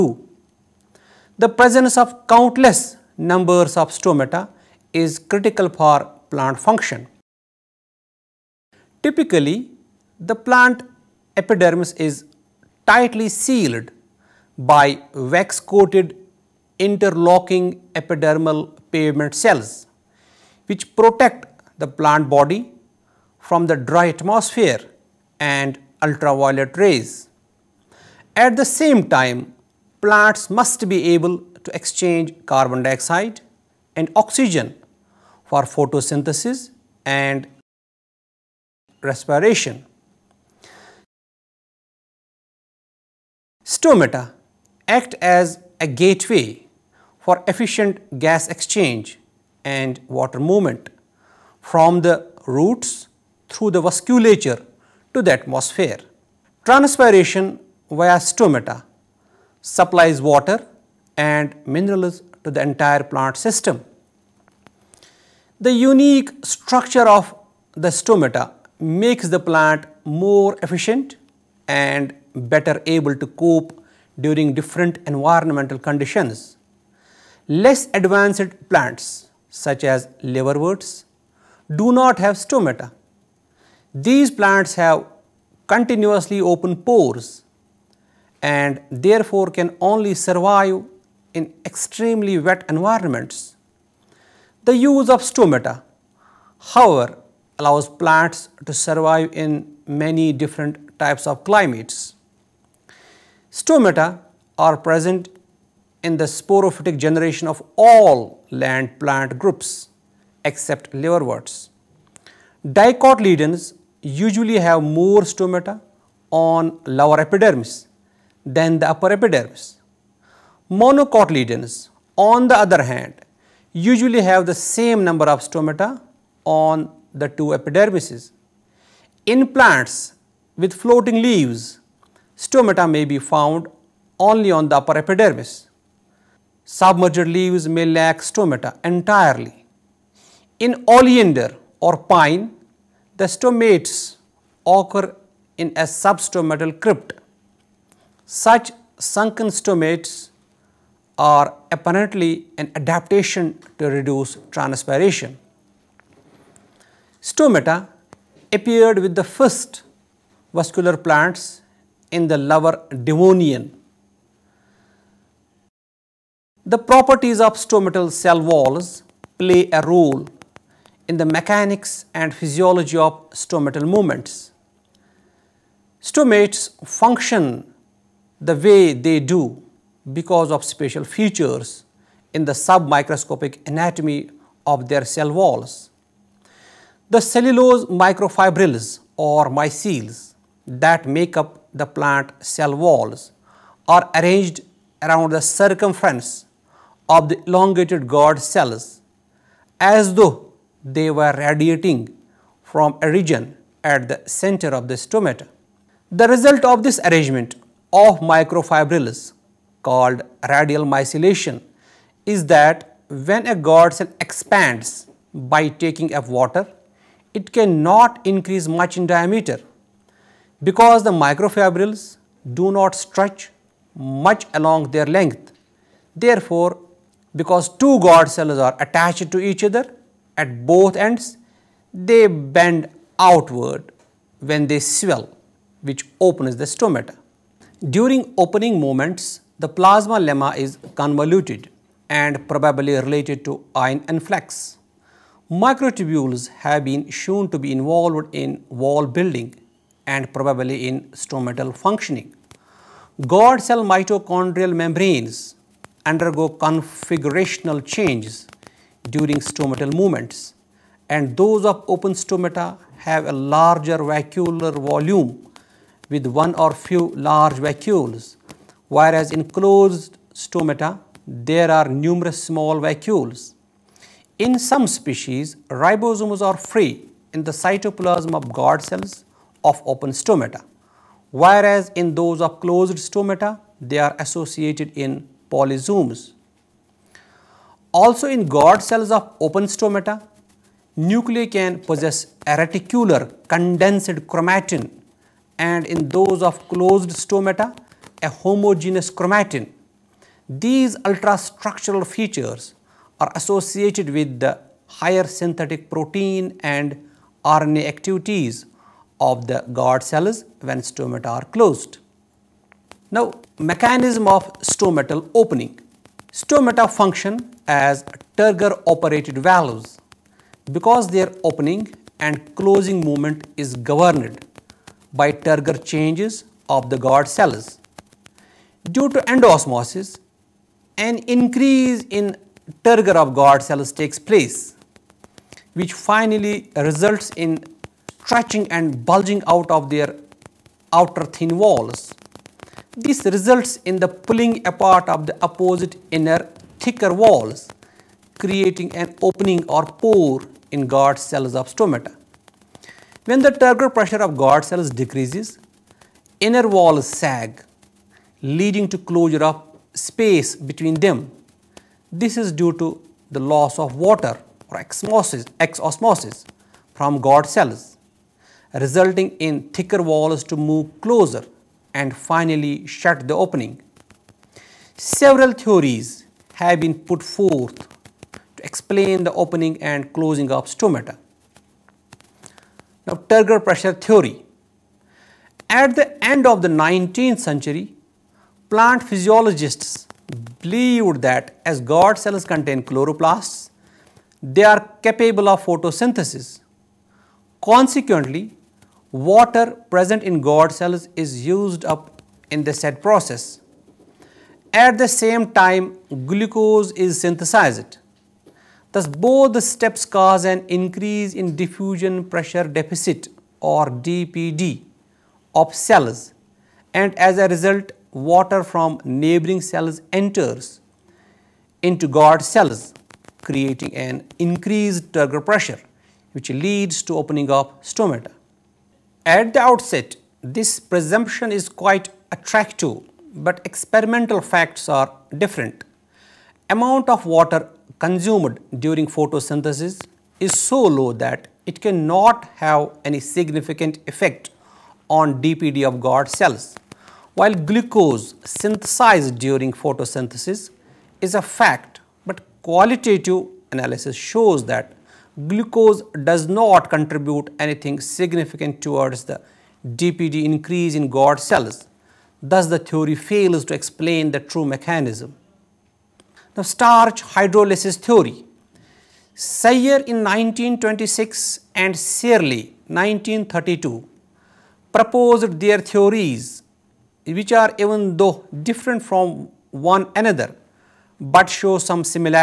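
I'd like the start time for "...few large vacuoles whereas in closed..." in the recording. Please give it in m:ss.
4:26.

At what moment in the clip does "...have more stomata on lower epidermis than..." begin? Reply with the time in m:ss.
1:54.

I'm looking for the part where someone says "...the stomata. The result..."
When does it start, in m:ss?
3:24.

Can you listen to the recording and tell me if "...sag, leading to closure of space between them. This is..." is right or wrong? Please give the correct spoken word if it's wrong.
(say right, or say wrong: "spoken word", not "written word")
right.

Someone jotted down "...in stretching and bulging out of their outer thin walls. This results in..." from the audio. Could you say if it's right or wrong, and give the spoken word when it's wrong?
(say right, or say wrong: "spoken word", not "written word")
right.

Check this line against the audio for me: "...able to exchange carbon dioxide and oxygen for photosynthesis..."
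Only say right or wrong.
right.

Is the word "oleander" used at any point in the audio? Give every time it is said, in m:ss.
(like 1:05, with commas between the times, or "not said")
2:20.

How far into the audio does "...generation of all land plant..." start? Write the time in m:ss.
1:47.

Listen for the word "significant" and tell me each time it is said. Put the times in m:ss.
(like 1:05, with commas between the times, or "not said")
7:23, 7:37.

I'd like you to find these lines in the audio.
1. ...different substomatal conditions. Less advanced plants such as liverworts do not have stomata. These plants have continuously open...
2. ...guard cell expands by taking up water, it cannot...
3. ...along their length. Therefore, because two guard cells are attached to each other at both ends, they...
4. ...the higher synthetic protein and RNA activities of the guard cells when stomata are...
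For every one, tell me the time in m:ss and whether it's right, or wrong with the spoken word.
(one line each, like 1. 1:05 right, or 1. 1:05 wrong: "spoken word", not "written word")
1. 1:14 wrong: "environmental", not "substomatal"
2. 3:33 right
3. 3:44 right
4. 5:04 right.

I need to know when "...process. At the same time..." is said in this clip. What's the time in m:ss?
6:42.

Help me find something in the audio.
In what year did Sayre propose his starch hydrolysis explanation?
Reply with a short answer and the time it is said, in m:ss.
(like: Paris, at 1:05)
1926, at 7:50.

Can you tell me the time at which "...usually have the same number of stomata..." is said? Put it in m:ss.
2:03.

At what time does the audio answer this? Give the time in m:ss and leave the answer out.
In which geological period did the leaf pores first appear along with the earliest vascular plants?
2:42.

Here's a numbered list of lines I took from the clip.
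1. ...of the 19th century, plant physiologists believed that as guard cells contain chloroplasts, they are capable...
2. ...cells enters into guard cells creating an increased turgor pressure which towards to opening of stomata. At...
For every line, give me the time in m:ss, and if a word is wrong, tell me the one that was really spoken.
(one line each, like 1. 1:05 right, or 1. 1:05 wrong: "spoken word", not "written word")
1. 6:26 right
2. 6:59 wrong: "leads", not "towards".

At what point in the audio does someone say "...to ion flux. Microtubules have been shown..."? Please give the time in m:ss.
4:03.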